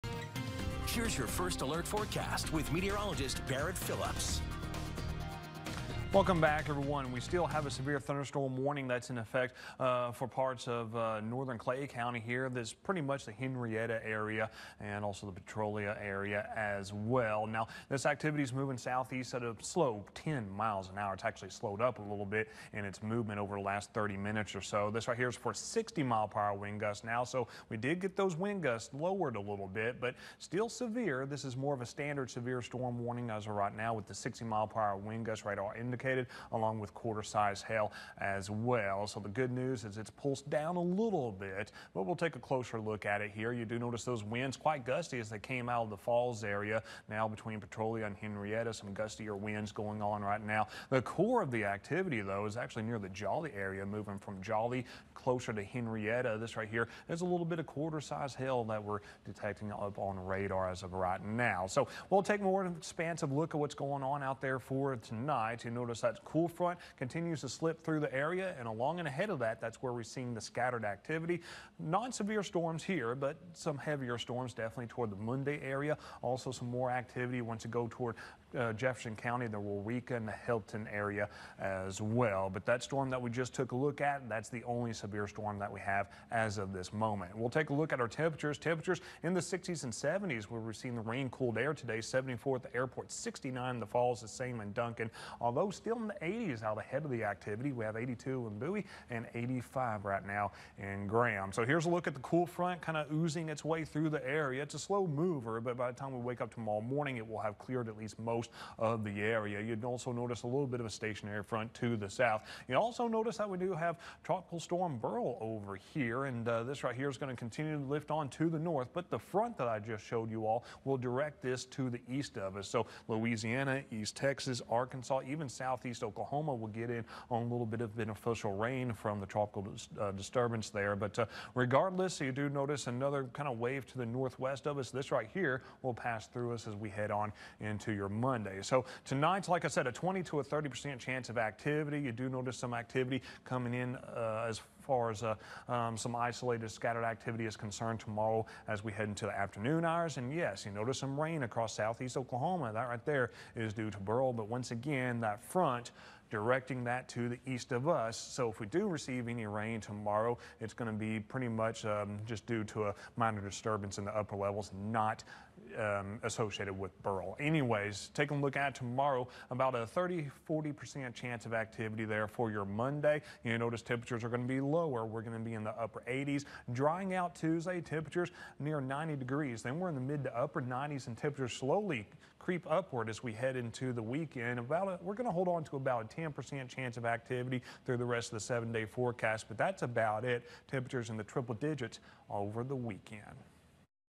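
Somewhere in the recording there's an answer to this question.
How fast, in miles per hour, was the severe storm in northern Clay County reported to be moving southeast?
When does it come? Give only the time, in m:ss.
0:20.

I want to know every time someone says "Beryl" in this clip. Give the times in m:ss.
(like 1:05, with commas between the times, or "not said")
1:54, 2:33, 2:47.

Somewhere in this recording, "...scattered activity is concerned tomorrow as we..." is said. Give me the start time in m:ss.
2:26.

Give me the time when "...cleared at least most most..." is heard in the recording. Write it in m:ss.
1:47.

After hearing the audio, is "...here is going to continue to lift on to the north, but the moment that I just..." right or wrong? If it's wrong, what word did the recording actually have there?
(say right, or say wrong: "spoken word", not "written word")
wrong: "front", not "moment".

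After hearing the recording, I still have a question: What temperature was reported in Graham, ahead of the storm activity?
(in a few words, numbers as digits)
85.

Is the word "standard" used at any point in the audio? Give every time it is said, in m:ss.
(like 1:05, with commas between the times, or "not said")
0:31.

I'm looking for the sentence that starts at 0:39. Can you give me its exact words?
So the good news is it's pulsed down a little bit, but we'll take a closer look at it here.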